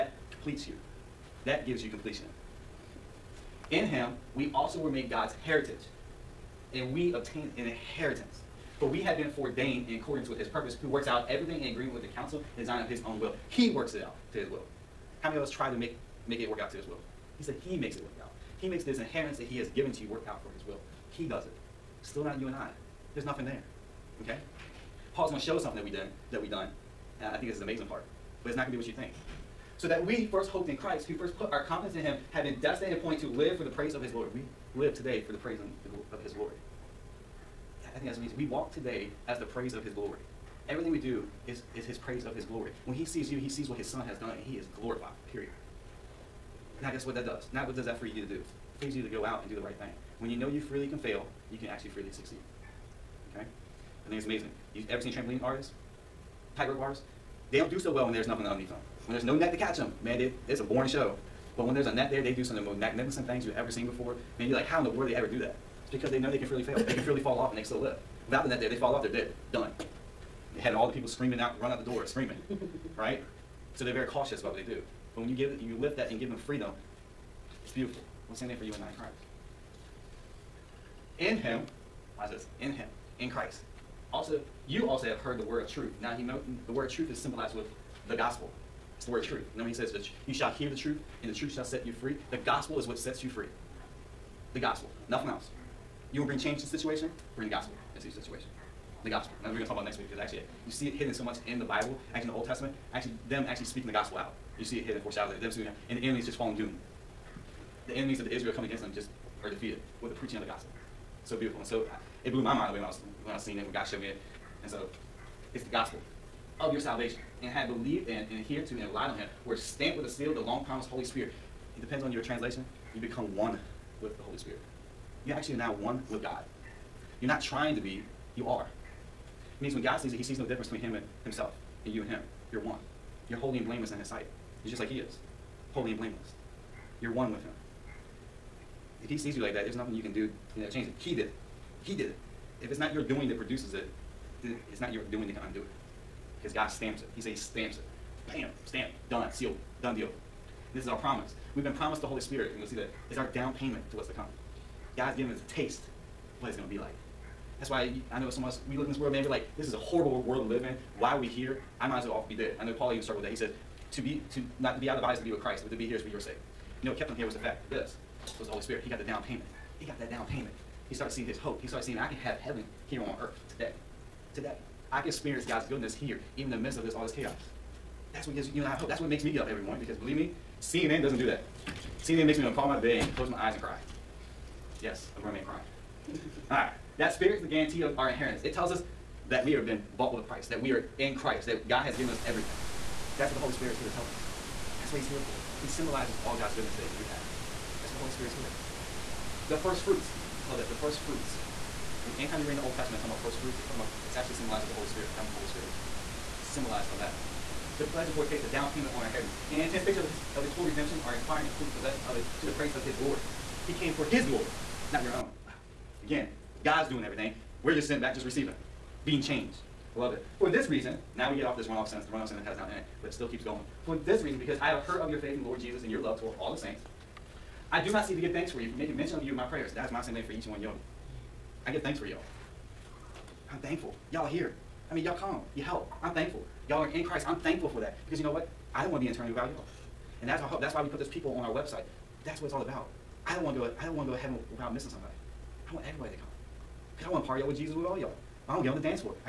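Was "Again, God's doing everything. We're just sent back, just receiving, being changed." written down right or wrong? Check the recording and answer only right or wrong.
right.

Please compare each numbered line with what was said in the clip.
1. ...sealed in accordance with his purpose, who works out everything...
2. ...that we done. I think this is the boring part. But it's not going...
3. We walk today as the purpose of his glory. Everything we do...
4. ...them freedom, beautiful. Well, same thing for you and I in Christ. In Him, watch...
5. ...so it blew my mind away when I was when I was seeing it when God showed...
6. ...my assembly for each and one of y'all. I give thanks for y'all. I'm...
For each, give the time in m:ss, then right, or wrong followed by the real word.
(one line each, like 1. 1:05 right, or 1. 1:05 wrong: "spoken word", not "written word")
1. 0:09 wrong: "foreordained", not "sealed"
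2. 0:26 wrong: "amazing", not "boring"
3. 0:38 wrong: "praise", not "purpose"
4. 1:16 right
5. 1:51 right
6. 3:49 right.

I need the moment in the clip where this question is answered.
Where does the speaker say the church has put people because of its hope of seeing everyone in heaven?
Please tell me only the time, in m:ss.
4:01.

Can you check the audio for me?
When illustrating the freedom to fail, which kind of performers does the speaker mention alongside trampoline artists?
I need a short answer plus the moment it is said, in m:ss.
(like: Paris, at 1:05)
Tightrope artists, at 0:56.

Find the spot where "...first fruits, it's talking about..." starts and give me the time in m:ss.
3:23.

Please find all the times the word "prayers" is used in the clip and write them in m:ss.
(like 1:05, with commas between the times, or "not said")
3:49.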